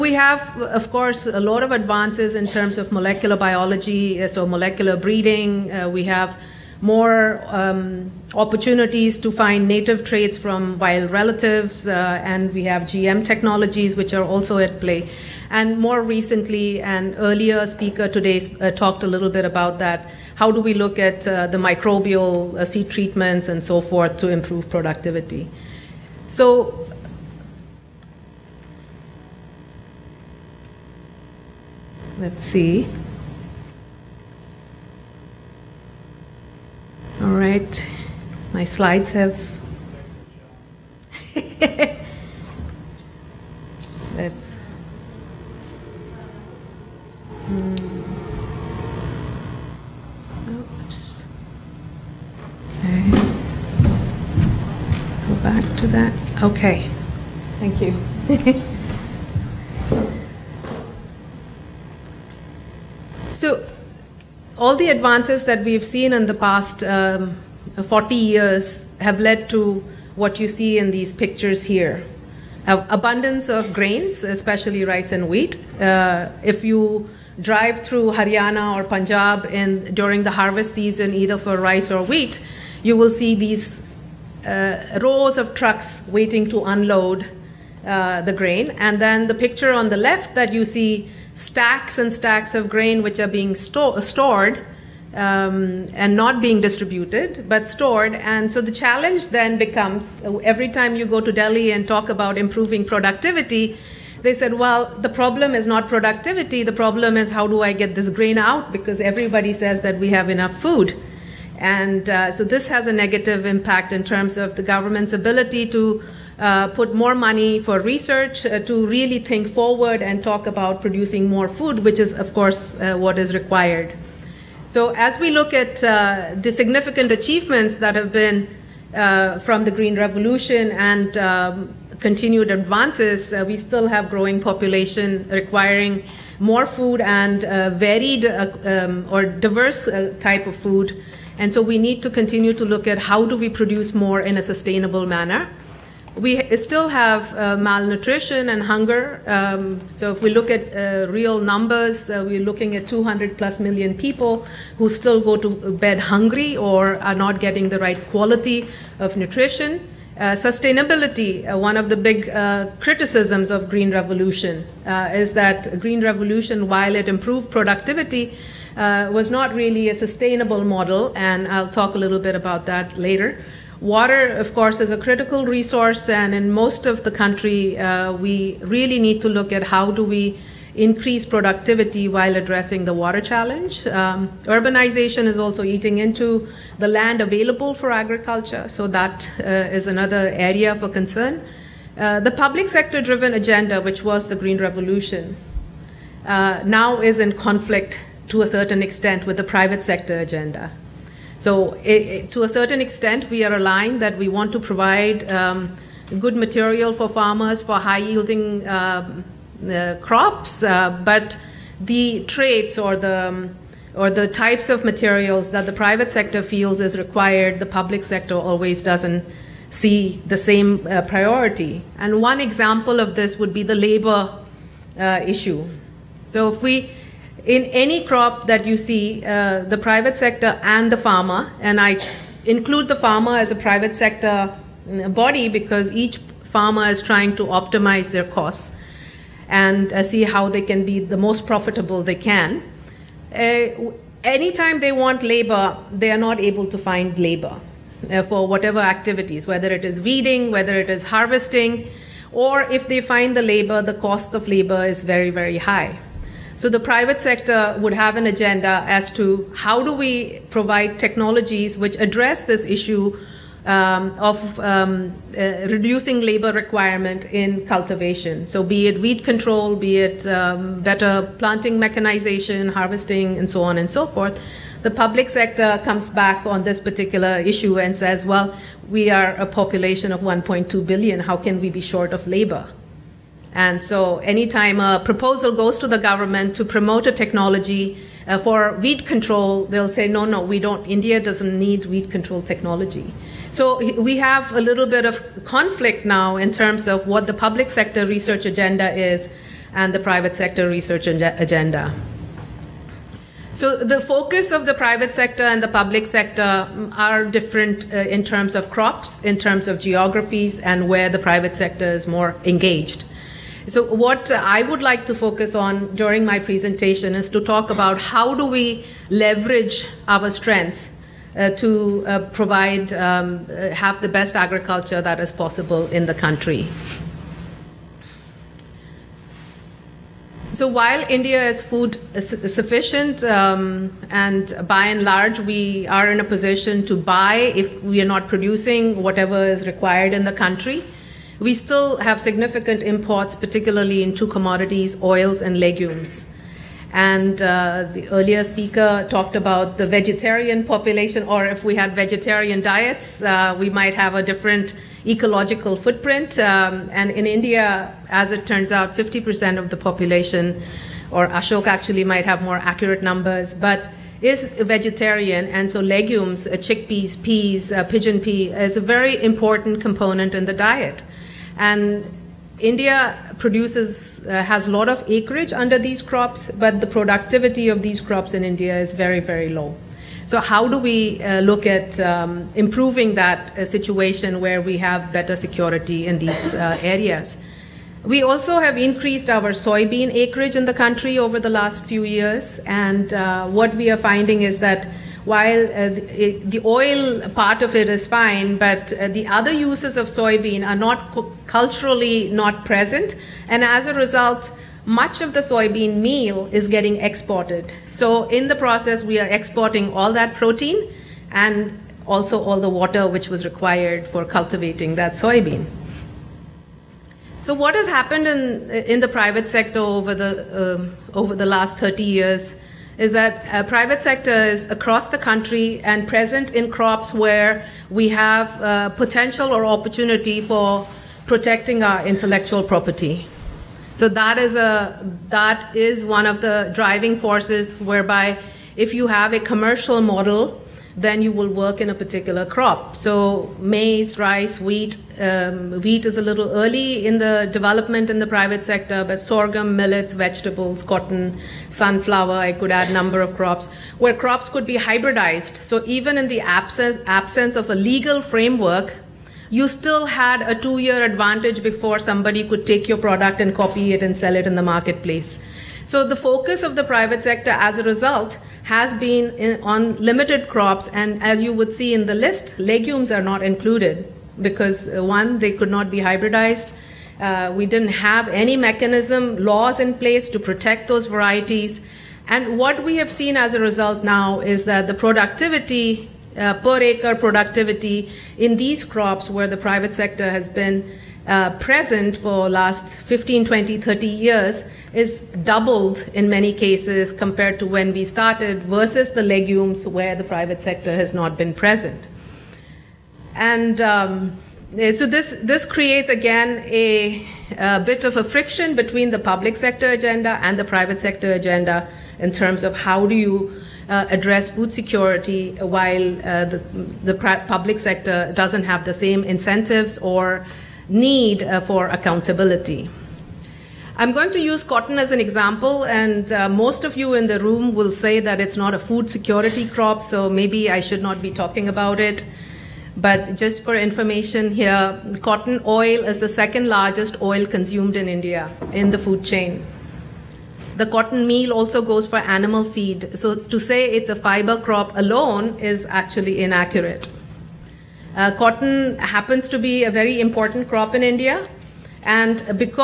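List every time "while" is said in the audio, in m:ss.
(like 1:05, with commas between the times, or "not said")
2:46, 3:02, 5:30, 6:35, 8:35.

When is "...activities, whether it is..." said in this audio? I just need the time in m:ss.
4:08.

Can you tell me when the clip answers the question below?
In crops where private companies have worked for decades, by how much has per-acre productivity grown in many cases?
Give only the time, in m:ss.
8:15.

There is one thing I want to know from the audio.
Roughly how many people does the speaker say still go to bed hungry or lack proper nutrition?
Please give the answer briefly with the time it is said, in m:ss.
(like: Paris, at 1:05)
200 plus million, at 2:32.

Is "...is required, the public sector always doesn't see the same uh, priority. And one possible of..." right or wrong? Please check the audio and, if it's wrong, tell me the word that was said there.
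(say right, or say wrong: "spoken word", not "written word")
wrong: "example", not "possible".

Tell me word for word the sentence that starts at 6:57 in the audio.
So what has happened in in the private sector over the um, over the last 30 years?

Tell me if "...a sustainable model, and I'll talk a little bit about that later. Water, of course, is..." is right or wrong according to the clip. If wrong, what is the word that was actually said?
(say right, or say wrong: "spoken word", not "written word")
right.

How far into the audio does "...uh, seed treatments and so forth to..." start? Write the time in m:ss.
0:22.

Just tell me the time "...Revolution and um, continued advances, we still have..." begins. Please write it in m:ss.
2:09.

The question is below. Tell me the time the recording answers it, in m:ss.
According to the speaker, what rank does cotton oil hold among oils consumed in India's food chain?
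8:56.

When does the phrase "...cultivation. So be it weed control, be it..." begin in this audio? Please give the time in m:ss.
4:27.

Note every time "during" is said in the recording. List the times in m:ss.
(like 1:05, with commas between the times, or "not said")
1:19, 5:15.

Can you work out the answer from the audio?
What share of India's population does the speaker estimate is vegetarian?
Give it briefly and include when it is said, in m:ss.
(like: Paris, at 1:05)
50%, at 5:58.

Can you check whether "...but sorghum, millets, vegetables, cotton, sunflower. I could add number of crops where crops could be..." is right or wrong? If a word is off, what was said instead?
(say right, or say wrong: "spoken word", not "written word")
right.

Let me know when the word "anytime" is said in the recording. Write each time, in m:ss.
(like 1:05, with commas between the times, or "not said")
4:04, 4:44.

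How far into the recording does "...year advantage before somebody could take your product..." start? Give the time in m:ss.
7:40.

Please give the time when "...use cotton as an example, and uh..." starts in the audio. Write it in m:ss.
8:44.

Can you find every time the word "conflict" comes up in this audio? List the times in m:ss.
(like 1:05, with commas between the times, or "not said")
3:17, 4:55.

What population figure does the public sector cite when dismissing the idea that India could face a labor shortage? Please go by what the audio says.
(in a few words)
1.2 billion.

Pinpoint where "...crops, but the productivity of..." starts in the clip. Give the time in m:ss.
6:16.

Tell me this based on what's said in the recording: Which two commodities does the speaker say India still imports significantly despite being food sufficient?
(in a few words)
oils and legumes.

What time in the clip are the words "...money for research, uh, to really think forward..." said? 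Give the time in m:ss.
1:57.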